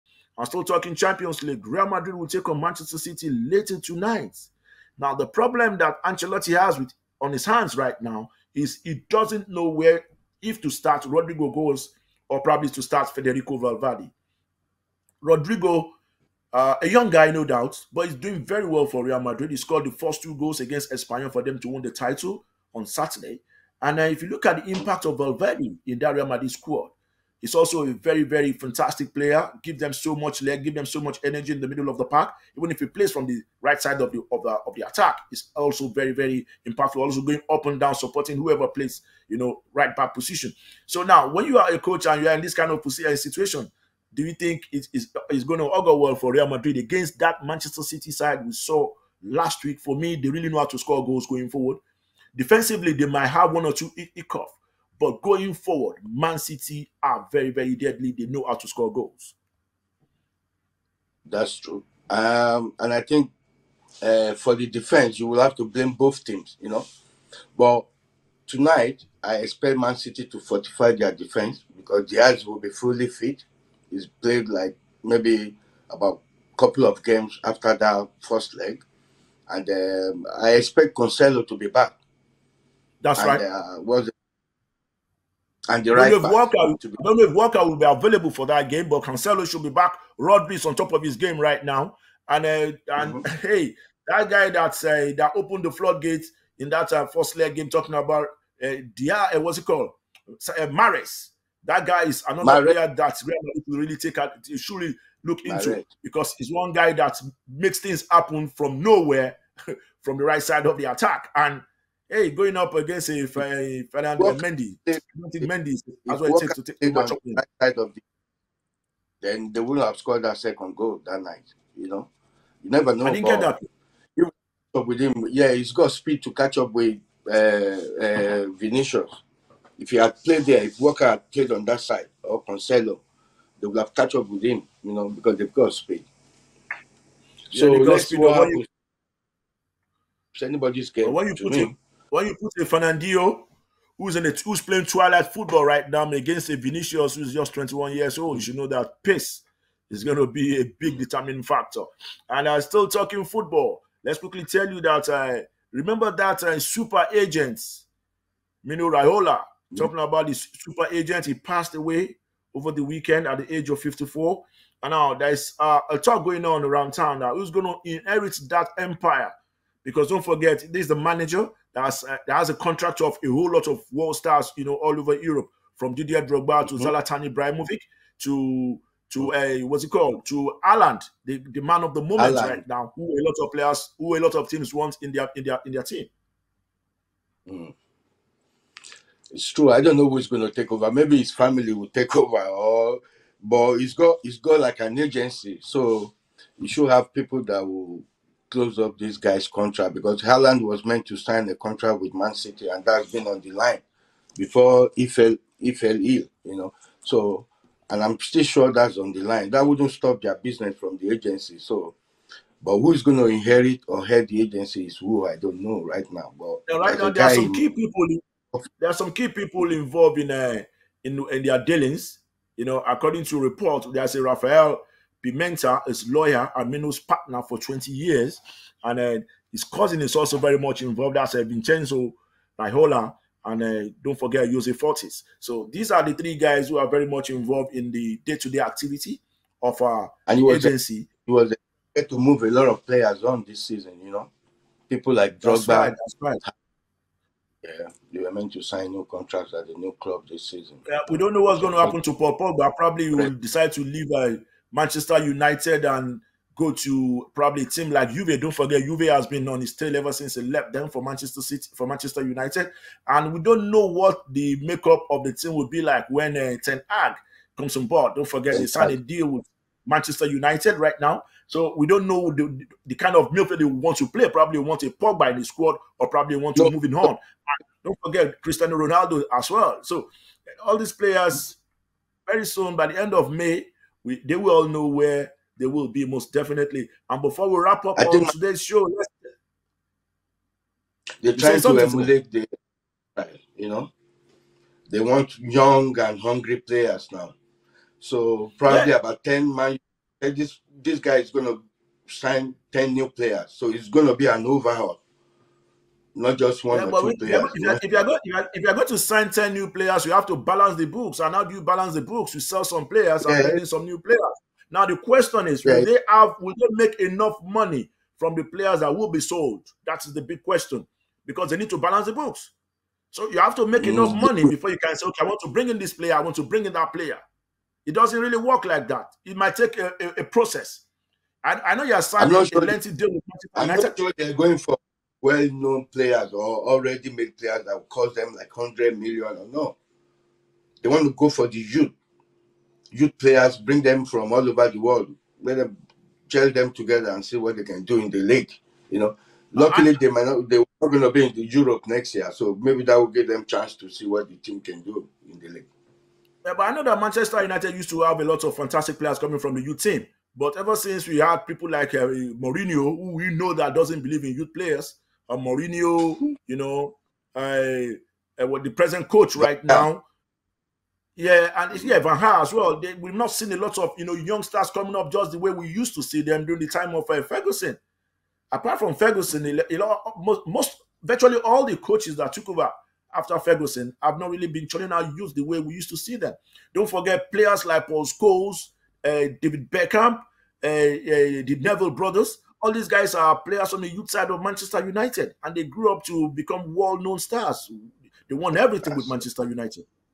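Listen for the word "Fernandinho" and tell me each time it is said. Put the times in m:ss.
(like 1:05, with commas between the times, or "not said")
2:22.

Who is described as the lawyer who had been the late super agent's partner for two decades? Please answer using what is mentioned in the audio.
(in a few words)
Rafael Pimenta.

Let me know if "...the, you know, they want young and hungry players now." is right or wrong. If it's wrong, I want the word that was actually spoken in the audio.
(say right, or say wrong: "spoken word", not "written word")
right.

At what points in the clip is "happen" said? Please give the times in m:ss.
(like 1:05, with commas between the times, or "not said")
1:48, 2:18, 4:11.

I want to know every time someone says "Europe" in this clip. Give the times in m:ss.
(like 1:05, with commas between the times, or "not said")
2:55, 5:51.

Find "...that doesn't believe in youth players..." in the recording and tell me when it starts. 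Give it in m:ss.
6:03.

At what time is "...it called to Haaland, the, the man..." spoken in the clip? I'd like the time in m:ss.
2:59.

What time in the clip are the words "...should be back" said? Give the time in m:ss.
1:29.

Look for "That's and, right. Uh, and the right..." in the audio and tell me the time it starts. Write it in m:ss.
1:23.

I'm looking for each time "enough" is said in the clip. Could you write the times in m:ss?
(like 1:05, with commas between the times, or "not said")
5:16, 5:23.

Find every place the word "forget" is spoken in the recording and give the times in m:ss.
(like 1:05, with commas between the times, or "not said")
2:50, 3:54, 4:18, 4:28, 4:38, 6:26.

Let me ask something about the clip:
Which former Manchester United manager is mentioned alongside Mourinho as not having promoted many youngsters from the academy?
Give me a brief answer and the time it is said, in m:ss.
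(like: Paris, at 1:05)
Van Gaal, at 6:11.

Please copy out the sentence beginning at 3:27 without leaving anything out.
So and I'm still sure that's on the line.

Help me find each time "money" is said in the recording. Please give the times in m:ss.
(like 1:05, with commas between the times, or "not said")
5:17, 5:24.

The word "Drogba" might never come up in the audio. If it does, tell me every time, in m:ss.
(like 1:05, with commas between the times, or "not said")
2:56, 4:05.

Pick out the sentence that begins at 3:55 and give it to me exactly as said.
So these are the three guys who are very much involved in the day-to-day -day activity of our and he was agency.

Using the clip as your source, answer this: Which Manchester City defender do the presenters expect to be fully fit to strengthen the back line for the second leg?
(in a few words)
Dias.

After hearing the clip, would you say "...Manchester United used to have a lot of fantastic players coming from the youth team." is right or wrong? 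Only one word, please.
right.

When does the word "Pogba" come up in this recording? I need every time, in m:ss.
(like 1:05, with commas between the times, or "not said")
4:12, 4:34.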